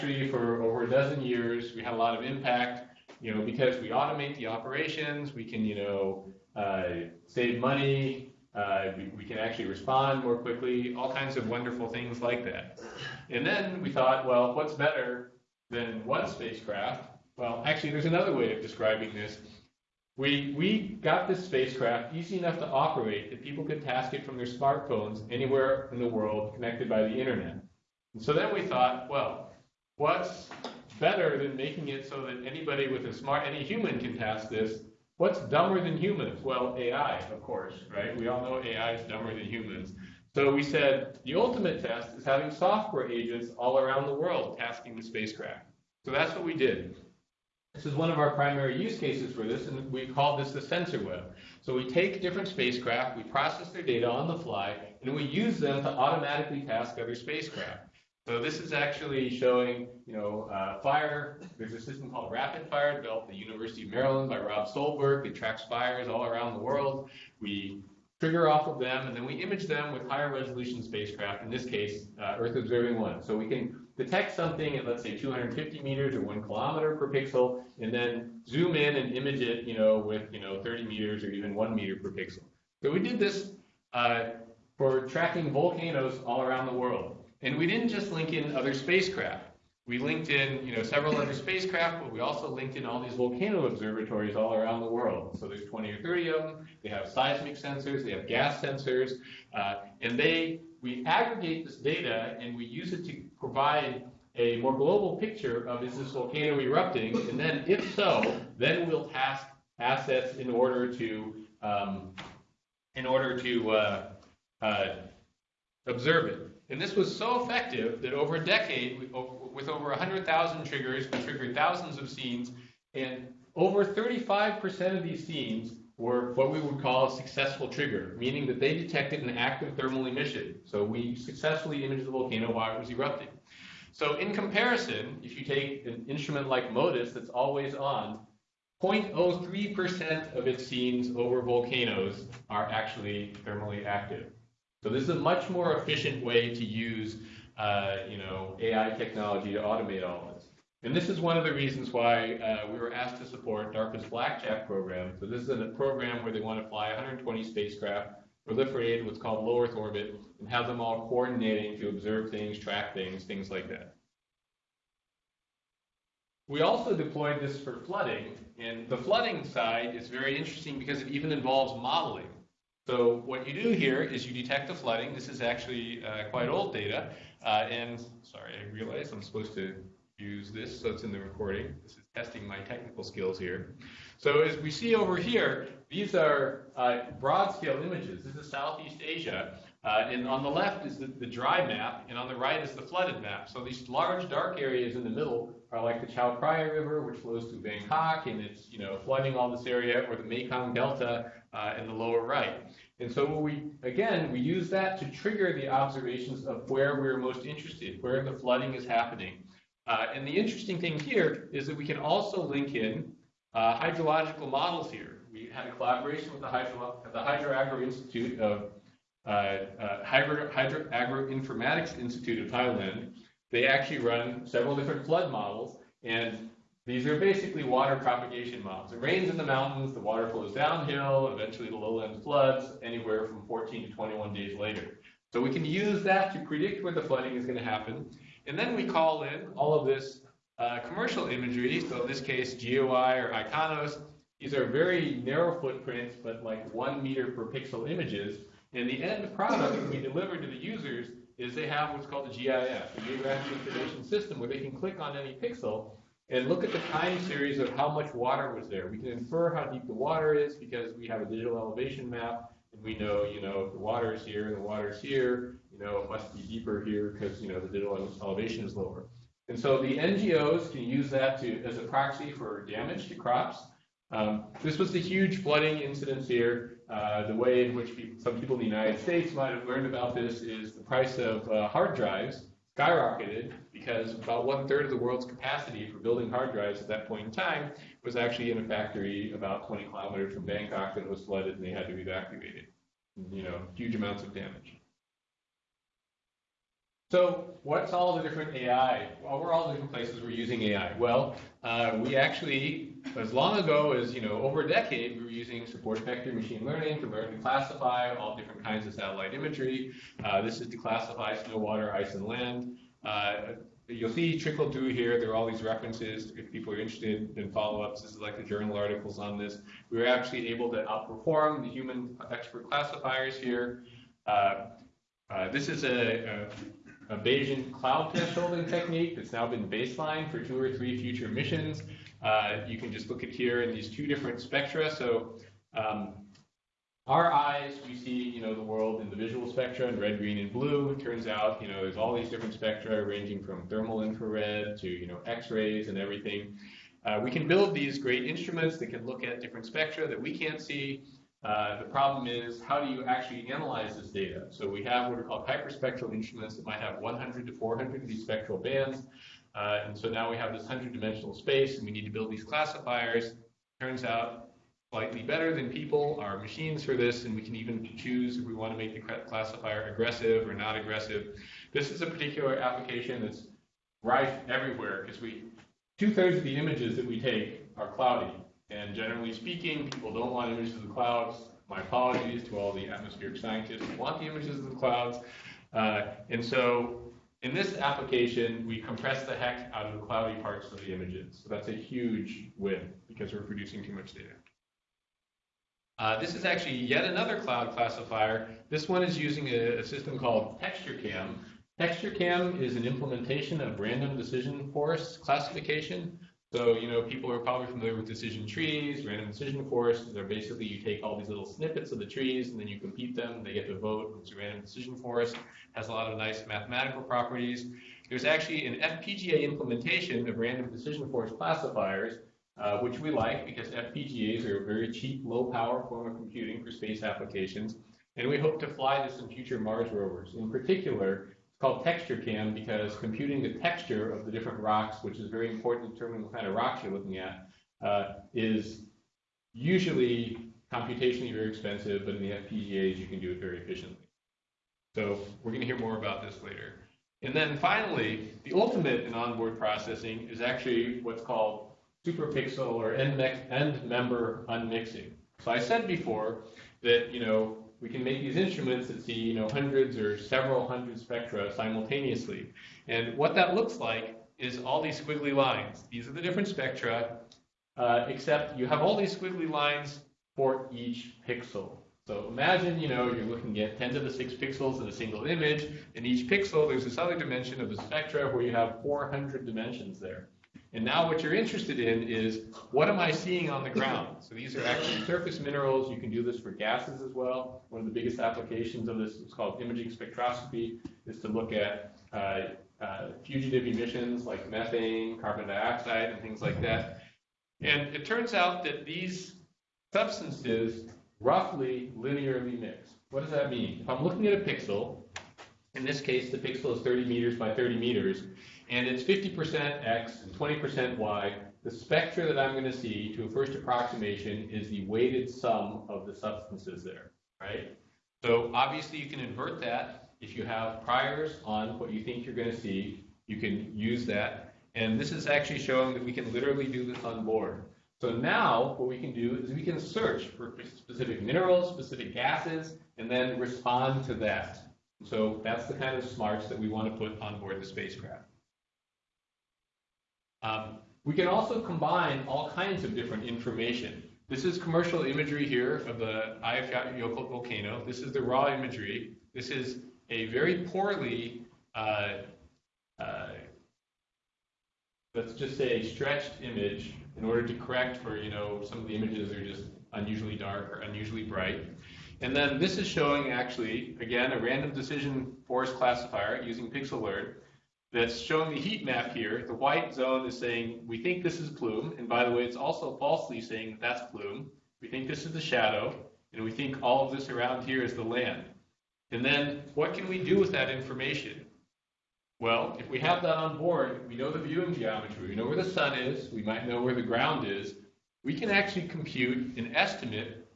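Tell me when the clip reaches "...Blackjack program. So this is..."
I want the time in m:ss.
2:34.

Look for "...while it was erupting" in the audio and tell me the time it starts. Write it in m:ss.
2:12.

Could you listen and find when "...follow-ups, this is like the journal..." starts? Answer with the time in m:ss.
5:17.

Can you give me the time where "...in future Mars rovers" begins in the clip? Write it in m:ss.
7:09.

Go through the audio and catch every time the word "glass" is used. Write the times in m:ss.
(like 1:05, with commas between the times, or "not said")
not said.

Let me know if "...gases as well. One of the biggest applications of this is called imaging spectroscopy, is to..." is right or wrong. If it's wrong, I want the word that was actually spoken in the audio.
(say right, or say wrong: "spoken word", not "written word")
right.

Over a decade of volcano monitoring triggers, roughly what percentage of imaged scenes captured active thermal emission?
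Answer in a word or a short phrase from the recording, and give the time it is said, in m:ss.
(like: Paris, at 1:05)
35%, at 2:03.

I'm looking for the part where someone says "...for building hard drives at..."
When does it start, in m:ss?
4:45.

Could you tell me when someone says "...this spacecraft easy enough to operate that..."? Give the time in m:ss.
0:21.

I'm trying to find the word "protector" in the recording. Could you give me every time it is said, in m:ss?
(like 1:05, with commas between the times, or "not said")
not said.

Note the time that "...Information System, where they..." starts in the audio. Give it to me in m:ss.
4:13.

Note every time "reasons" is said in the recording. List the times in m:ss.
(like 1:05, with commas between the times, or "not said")
2:31.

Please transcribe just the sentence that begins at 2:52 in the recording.
So what you do here is you detect the flooding.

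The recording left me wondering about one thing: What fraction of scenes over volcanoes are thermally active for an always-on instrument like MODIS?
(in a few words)
0.03%.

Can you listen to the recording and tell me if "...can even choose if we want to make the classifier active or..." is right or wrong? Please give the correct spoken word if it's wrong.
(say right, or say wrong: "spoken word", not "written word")
wrong: "aggressive", not "active".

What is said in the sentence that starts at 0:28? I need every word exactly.
And so then we thought, well, what's better than making it so that anybody with a smart, any human can task this?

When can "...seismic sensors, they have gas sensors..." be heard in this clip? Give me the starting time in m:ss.
1:37.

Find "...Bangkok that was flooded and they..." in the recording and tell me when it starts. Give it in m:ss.
4:50.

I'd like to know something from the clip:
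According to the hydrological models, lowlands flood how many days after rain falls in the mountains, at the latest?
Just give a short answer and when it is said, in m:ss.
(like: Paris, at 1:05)
21, at 3:53.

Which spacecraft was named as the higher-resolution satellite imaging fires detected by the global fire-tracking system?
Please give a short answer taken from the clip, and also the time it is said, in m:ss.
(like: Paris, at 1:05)
Earth Observing 1, at 1:12.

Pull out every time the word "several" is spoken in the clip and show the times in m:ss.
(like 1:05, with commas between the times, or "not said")
1:30, 3:44, 7:40.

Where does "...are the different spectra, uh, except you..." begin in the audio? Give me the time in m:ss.
7:46.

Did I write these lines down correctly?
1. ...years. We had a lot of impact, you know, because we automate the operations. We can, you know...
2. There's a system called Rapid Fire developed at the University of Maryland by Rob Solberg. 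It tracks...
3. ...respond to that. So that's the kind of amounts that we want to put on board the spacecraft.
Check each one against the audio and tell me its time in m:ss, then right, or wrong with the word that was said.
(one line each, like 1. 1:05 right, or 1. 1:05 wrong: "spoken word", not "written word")
1. 0:01 right
2. 1:01 right
3. 8:53 wrong: "smarts", not "amounts".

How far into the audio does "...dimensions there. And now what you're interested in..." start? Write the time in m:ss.
7:59.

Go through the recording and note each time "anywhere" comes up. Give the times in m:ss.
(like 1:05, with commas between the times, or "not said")
0:25, 3:52.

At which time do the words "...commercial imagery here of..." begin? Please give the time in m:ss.
9:04.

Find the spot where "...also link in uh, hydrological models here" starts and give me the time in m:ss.
3:31.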